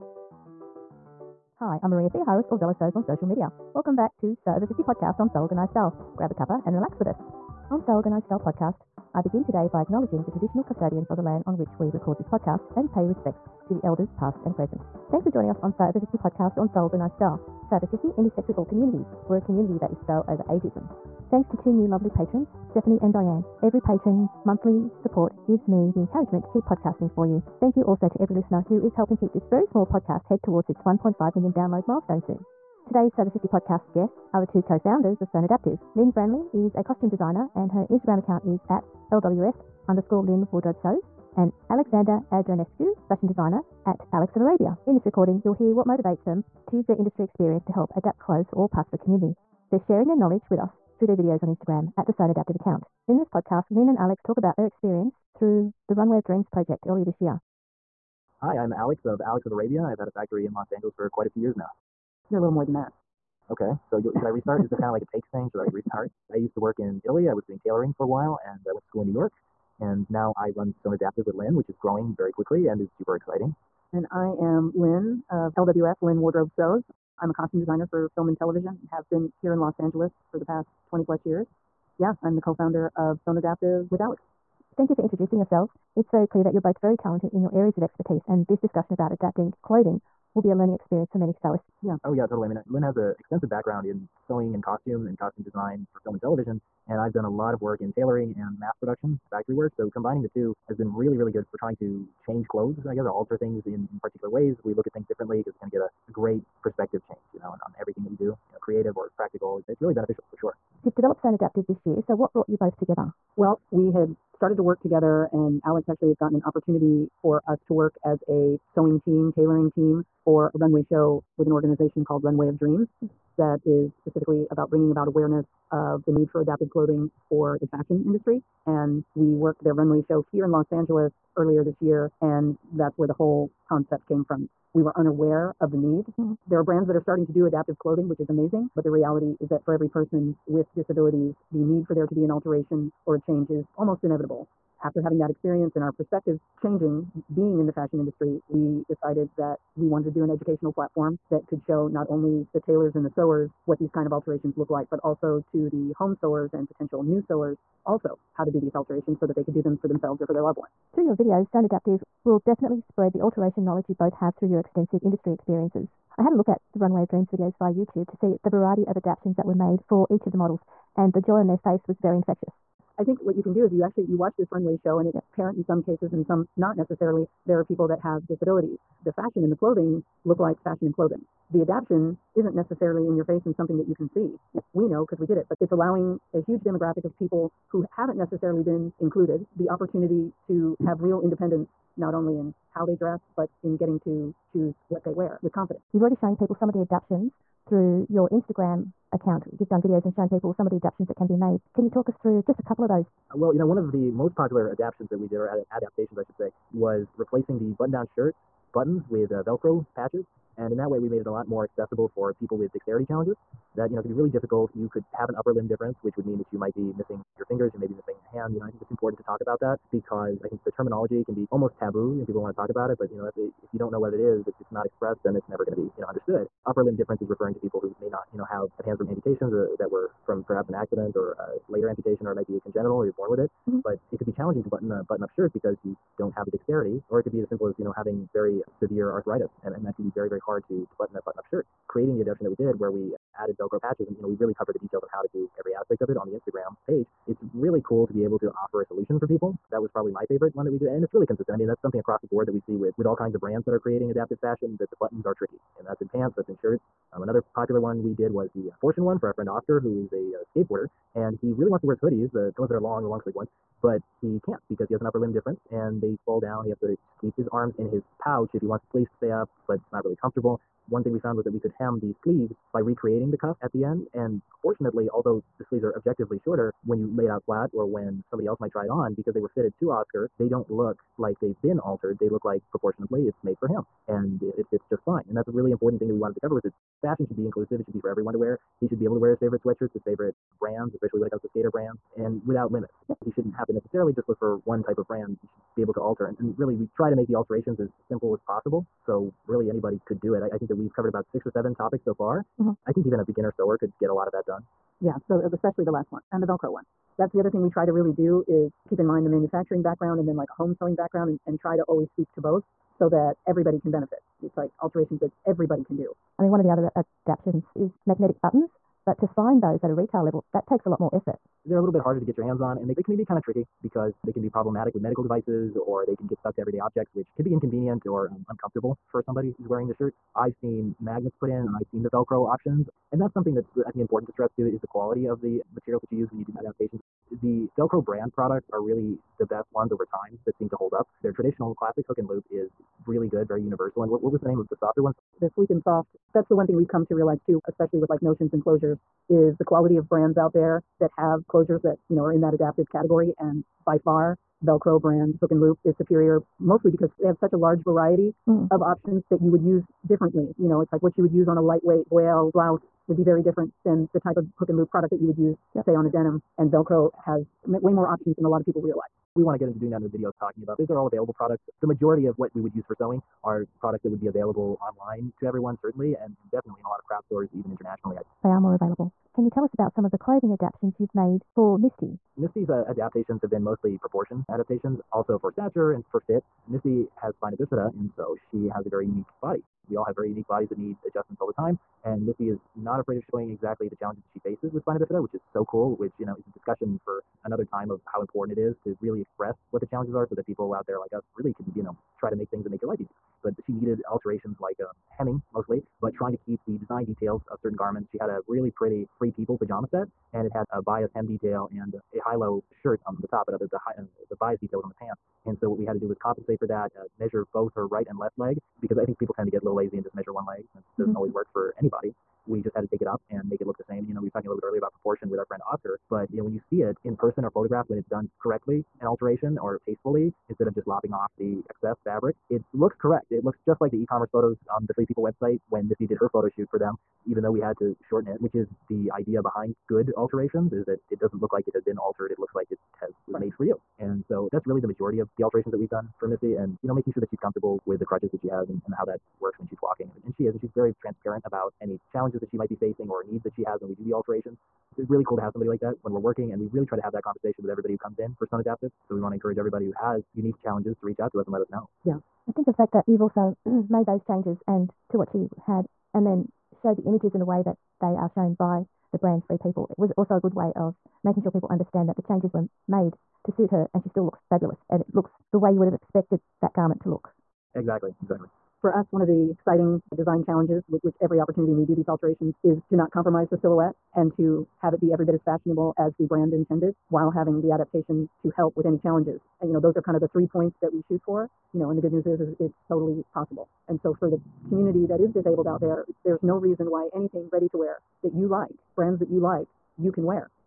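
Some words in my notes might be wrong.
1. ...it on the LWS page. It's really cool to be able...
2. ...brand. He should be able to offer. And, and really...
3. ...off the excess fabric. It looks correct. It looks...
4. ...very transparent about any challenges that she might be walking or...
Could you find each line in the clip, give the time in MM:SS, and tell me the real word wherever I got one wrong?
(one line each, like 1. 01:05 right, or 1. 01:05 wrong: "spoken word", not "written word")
1. 04:06 wrong: "Instagram", not "LWS"
2. 04:55 wrong: "alter", not "offer"
3. 07:11 right
4. 07:30 wrong: "facing", not "walking".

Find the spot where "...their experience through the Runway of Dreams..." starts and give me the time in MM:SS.
00:54.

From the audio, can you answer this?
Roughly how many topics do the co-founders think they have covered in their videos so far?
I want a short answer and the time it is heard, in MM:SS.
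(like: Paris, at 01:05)
6 or 7, at 05:01.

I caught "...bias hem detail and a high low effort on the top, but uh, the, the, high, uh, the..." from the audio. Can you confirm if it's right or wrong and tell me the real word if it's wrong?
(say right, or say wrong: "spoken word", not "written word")
wrong: "shirt", not "effort".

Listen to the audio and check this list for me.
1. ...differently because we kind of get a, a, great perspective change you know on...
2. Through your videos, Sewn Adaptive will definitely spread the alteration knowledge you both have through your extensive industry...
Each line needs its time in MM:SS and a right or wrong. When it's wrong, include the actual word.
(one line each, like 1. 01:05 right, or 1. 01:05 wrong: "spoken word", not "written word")
1. 01:45 right
2. 02:40 right.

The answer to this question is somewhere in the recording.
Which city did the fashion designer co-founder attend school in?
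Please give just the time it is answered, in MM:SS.
01:09.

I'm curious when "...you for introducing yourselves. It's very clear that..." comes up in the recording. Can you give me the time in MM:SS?
01:24.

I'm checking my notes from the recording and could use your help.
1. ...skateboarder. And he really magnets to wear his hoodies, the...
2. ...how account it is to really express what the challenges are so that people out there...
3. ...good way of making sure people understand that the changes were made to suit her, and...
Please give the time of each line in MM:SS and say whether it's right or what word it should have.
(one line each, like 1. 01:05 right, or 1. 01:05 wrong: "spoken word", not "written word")
1. 04:20 wrong: "wants", not "magnets"
2. 06:38 wrong: "important", not "account"
3. 07:50 right.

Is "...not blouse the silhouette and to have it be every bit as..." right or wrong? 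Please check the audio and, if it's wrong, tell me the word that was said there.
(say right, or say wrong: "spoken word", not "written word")
wrong: "compromise", not "blouse".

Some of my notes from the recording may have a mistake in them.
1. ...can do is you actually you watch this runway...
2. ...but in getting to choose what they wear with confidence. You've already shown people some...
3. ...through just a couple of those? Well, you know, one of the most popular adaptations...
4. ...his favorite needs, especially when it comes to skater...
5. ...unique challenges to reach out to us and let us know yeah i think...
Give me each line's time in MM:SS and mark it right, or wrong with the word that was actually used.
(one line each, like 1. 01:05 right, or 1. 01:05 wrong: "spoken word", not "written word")
1. 02:53 right
2. 03:13 right
3. 03:22 right
4. 04:49 wrong: "brands", not "needs"
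5. 07:40 right.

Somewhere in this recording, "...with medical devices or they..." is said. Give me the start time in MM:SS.
05:24.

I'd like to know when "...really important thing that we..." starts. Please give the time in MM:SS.
04:45.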